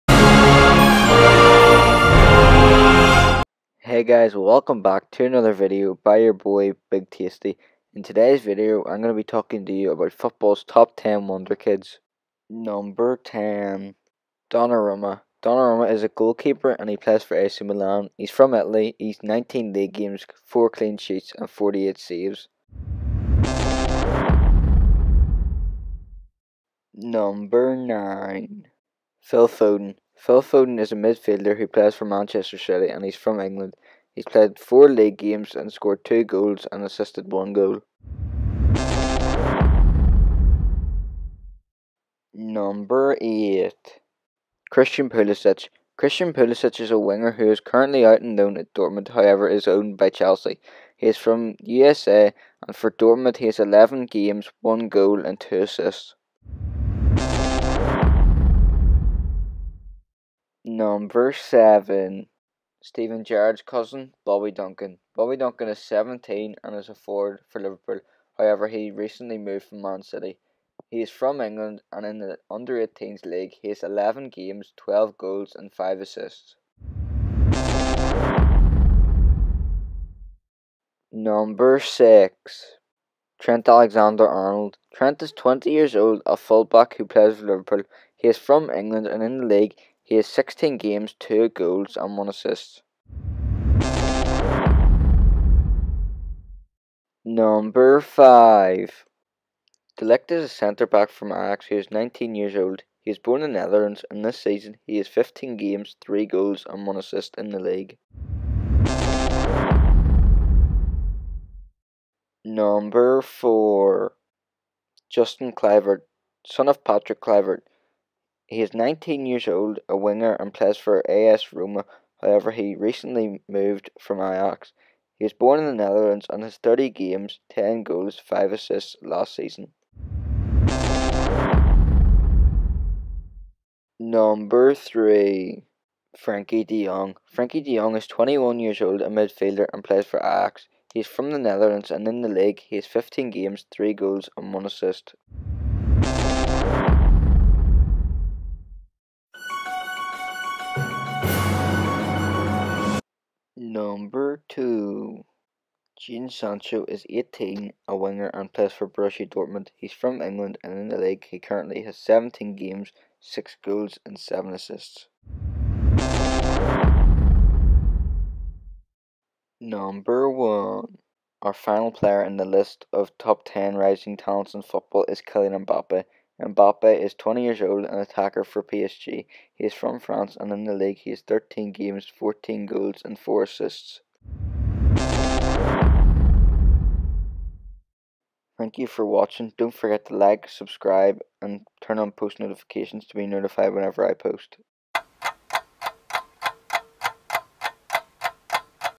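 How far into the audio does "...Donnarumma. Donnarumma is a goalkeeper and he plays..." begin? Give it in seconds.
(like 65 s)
14 s.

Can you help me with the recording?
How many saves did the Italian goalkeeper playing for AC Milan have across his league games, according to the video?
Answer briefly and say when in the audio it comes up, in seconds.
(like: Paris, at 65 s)
48, at 21 s.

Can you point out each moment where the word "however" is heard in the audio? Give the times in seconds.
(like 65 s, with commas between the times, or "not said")
49 s, 68 s, 122 s.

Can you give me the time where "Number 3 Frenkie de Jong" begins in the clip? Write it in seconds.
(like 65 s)
133 s.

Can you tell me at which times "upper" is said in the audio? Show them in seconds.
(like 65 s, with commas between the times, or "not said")
not said.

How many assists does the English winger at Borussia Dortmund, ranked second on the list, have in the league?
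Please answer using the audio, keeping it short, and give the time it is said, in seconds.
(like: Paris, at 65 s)
7, at 164 s.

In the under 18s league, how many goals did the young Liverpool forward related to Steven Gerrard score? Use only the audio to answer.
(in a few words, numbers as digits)
12.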